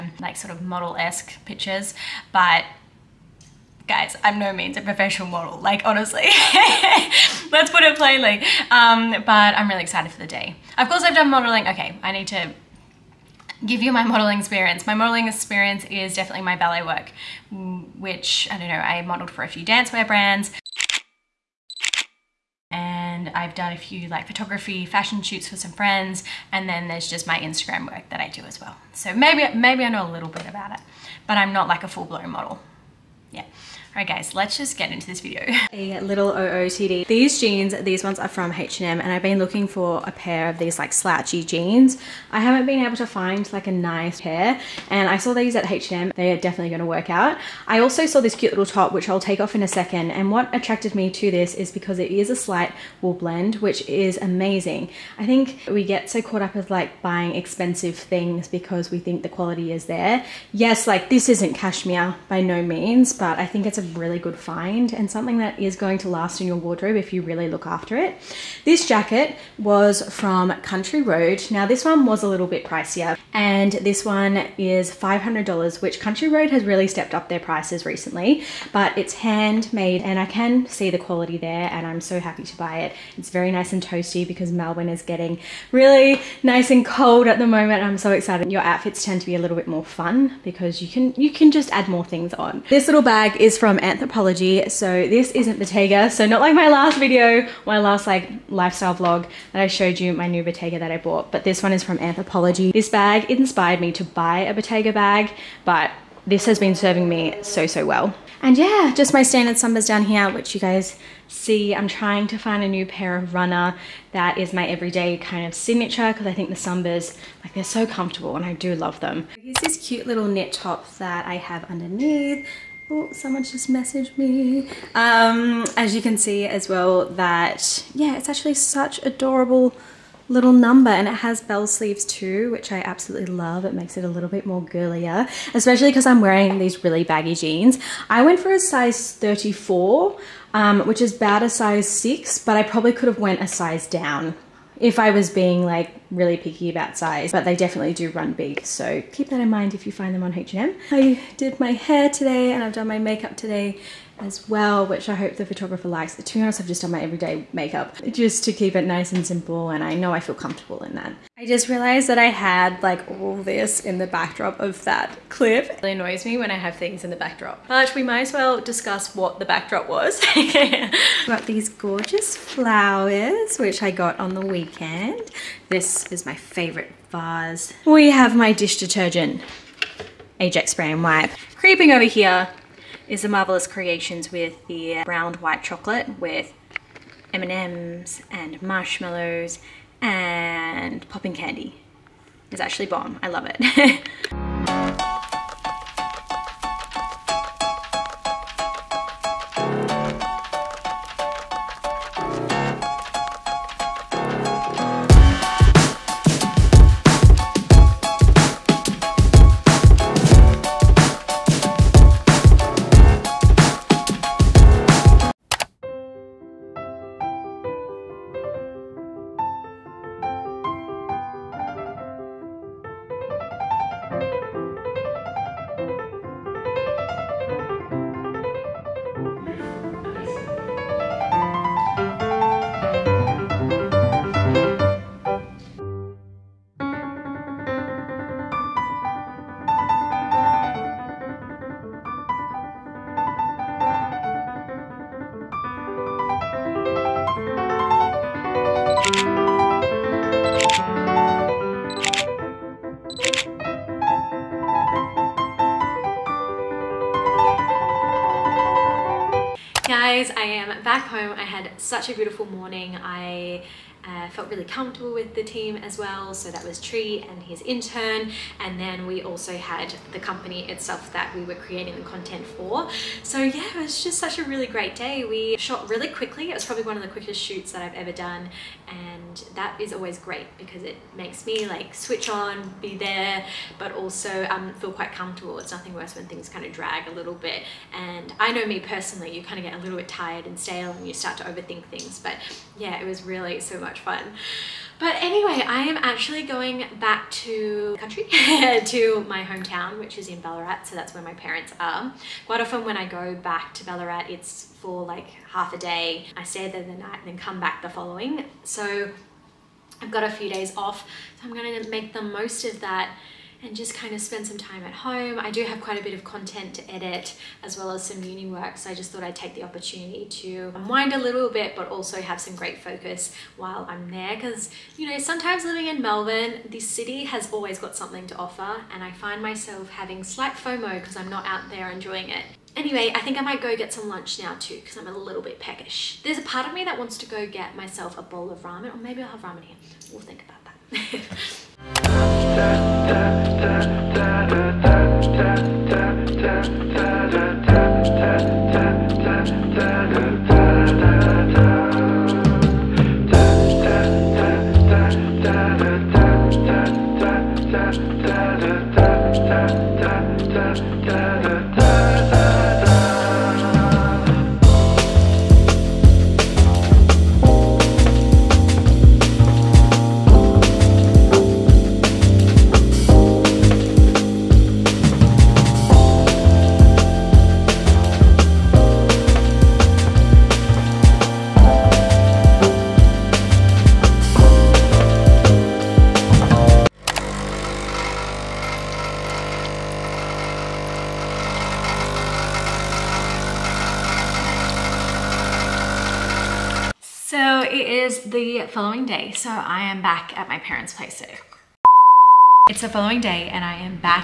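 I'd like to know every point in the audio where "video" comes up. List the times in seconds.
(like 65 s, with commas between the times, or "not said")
35 s, 96 s.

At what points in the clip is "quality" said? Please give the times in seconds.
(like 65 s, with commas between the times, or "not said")
59 s, 80 s.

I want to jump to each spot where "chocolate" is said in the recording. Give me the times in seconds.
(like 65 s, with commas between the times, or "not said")
185 s.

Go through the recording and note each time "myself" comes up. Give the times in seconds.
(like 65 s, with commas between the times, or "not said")
329 s, 337 s.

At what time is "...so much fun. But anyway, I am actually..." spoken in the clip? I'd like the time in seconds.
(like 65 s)
293 s.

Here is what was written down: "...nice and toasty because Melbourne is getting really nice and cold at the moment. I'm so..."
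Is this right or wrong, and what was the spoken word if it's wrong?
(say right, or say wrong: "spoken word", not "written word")
right.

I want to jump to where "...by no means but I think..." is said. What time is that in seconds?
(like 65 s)
62 s.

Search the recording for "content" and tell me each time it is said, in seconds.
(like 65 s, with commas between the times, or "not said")
272 s, 316 s.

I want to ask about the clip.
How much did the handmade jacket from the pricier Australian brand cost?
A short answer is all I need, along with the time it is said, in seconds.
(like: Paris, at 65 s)
$500, at 74 s.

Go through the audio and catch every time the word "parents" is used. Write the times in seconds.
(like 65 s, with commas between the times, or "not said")
301 s, 400 s.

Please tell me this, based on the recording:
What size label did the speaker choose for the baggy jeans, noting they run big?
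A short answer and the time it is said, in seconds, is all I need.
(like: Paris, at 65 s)
34, at 138 s.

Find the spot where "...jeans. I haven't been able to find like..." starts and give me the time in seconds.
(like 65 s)
41 s.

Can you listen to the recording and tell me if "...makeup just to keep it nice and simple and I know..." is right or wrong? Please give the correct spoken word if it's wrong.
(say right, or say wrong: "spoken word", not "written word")
right.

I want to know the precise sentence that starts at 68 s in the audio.
This jacket was from Country Road.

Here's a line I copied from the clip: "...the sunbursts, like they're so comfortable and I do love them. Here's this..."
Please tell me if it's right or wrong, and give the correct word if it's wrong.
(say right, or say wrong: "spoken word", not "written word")
right.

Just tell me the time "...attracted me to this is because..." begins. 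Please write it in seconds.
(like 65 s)
50 s.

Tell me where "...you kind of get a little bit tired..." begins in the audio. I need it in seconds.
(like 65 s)
289 s.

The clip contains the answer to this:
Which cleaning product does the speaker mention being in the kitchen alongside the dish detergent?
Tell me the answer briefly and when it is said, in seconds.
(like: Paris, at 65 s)
Ajax spray and wipe, at 180 s.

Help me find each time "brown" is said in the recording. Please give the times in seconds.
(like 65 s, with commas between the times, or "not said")
185 s.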